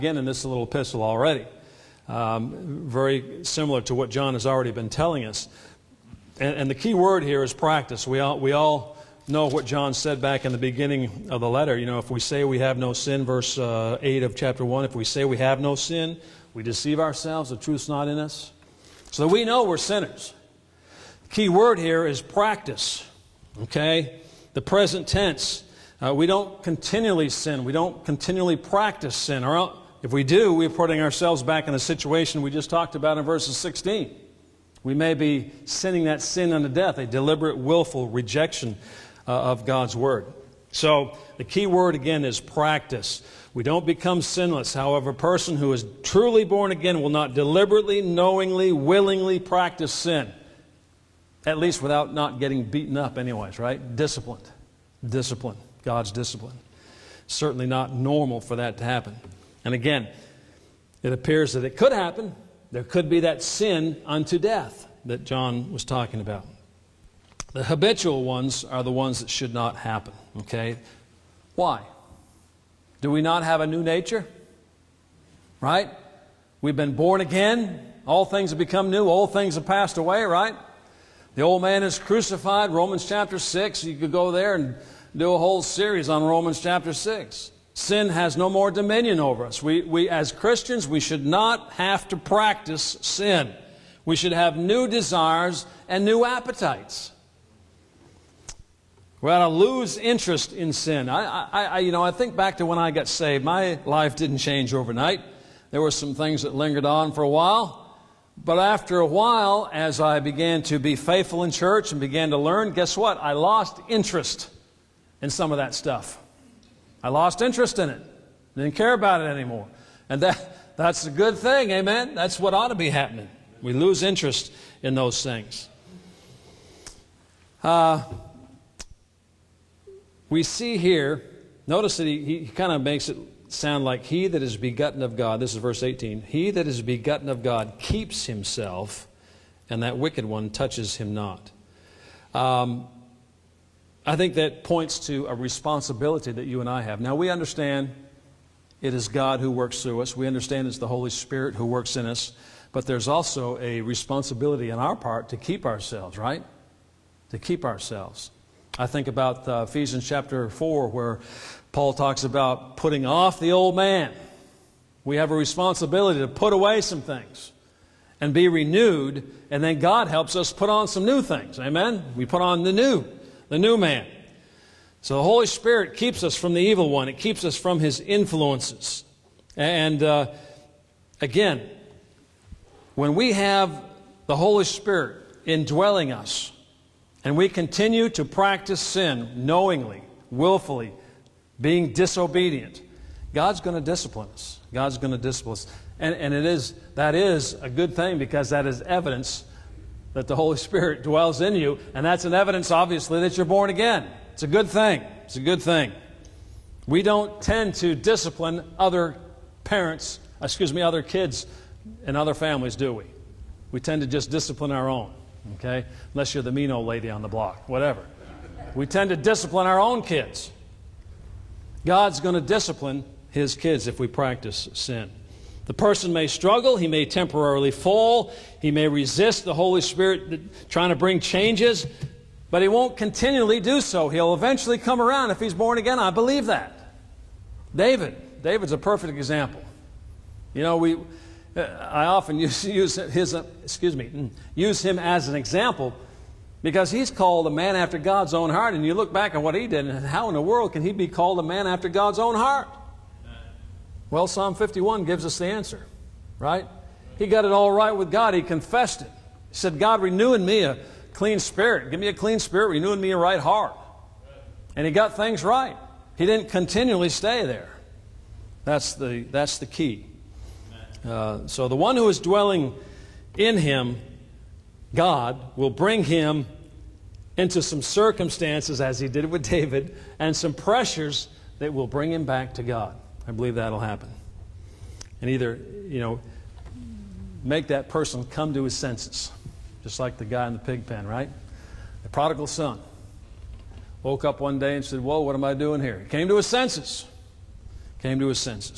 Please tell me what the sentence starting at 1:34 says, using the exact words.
We should have new desires and new appetites.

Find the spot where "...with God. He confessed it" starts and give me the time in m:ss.
4:17.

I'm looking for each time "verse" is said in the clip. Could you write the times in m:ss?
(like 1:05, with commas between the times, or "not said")
0:13, 0:33, 2:15.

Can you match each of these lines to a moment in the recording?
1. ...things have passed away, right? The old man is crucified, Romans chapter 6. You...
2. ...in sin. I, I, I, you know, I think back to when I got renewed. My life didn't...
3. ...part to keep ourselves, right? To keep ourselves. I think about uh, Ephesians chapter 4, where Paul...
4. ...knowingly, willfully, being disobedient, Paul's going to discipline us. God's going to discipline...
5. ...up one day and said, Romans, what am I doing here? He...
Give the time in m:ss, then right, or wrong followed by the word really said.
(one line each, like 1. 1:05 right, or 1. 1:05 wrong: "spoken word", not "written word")
1. 1:19 right
2. 1:40 wrong: "saved", not "renewed"
3. 2:34 right
4. 3:09 wrong: "God", not "Paul"
5. 4:54 wrong: "Whoa", not "Romans".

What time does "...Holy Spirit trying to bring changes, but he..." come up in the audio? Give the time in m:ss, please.
3:49.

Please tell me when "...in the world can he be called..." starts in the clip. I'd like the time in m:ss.
4:10.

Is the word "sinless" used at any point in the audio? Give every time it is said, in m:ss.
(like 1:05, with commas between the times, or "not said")
0:44.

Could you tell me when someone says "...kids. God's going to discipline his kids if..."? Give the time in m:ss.
3:40.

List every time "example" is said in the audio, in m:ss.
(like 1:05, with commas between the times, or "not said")
3:59, 4:05.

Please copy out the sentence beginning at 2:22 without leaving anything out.
Um, I think that points to a responsibility that you and I have.